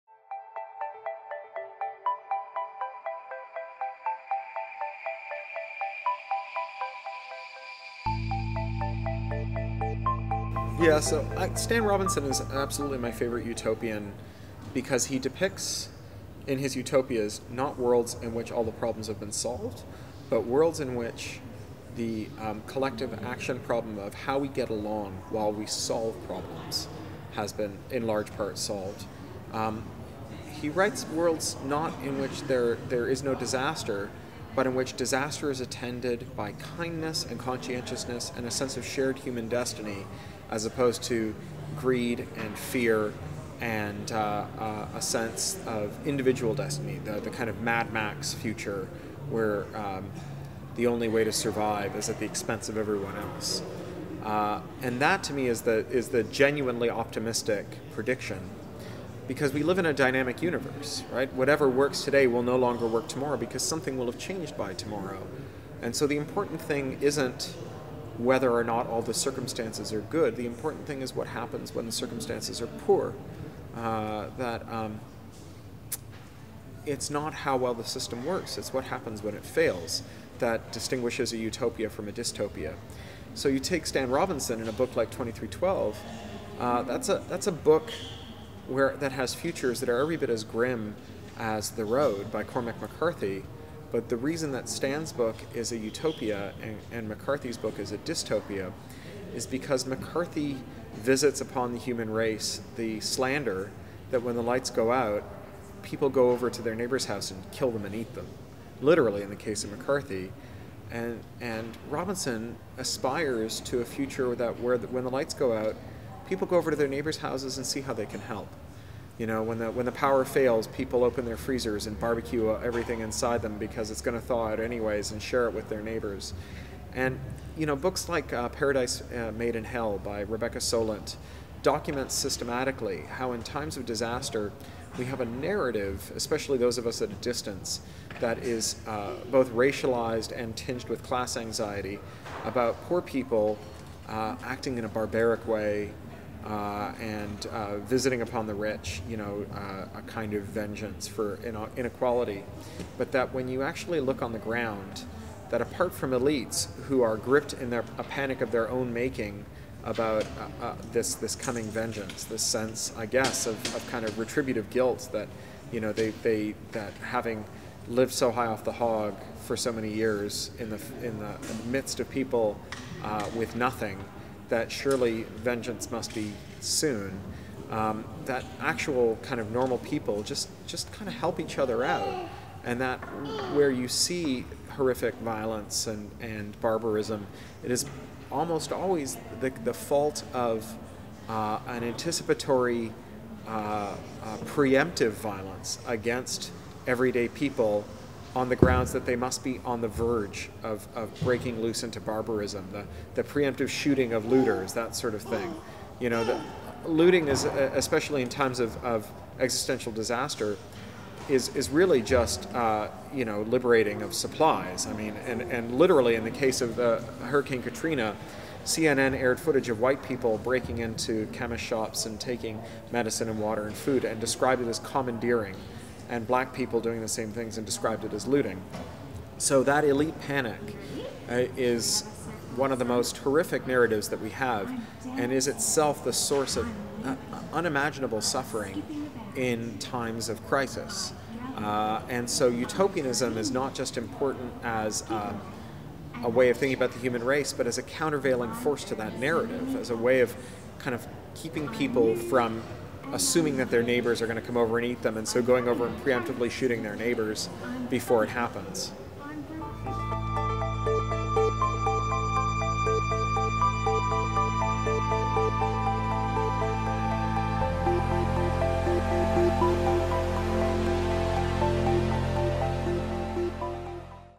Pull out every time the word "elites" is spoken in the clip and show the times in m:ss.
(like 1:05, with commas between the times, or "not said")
2:36, 3:49.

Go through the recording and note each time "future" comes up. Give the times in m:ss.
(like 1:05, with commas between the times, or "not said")
0:48, 1:29, 1:53.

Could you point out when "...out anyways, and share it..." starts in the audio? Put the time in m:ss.
2:04.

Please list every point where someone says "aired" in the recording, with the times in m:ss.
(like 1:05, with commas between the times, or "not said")
3:39.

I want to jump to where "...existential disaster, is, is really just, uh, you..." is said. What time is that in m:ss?
3:29.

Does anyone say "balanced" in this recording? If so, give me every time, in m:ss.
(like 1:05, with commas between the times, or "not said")
not said.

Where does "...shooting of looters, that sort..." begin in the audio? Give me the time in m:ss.
3:23.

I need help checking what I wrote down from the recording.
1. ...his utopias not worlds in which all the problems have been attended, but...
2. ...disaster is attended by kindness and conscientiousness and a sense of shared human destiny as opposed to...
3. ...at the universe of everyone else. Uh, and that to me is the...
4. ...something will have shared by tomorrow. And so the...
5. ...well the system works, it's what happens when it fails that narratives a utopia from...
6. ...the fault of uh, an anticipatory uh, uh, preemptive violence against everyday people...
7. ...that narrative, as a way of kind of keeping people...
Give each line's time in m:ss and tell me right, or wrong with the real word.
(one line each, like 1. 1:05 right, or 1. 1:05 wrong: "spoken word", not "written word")
1. 0:16 wrong: "solved", not "attended"
2. 0:34 right
3. 0:52 wrong: "expense", not "universe"
4. 1:03 wrong: "changed", not "shared"
5. 1:17 wrong: "distinguishes", not "narratives"
6. 3:09 right
7. 4:08 right.